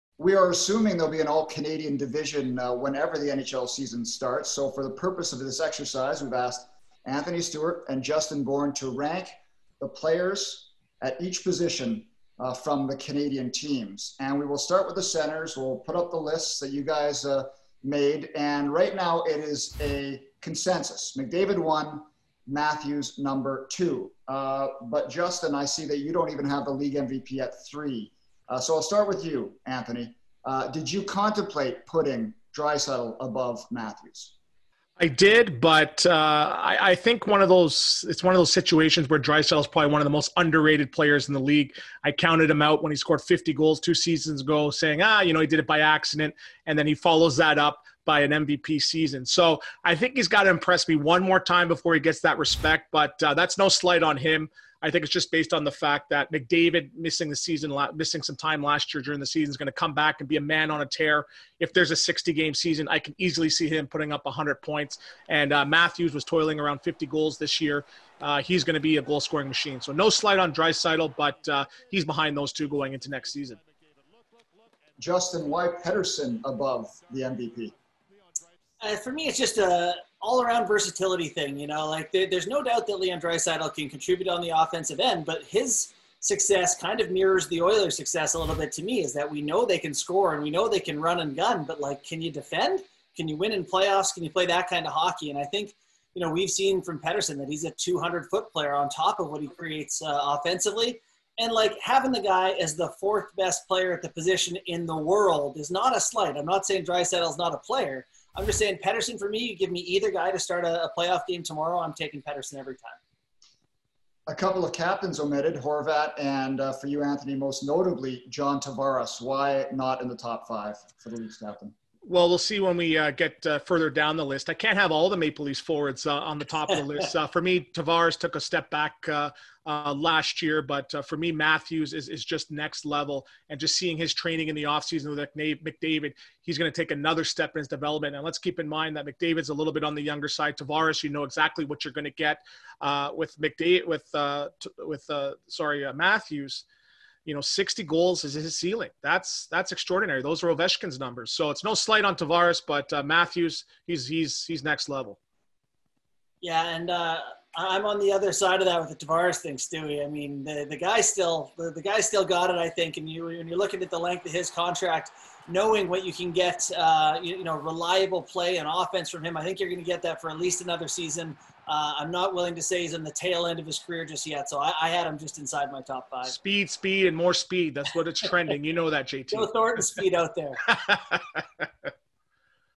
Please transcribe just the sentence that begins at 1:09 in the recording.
So no slight on Draisaitl, but uh, he's behind those two going into next season.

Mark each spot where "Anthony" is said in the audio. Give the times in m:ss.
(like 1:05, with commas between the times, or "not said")
0:07, 0:29, 1:57.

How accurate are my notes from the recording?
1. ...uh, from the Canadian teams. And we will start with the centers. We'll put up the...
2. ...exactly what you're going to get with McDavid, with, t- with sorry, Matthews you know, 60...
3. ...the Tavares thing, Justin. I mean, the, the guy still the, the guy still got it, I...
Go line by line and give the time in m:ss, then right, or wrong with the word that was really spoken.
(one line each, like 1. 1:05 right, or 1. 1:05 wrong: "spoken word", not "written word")
1. 0:12 right
2. 2:21 right
3. 2:38 wrong: "Stewie", not "Justin".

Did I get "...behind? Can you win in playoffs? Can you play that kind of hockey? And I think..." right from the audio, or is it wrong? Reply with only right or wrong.
wrong.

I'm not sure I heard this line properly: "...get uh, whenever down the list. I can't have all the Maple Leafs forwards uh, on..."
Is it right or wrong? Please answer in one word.
wrong.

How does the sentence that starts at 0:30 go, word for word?
Uh, did you contemplate putting Draisaitl above Matthews?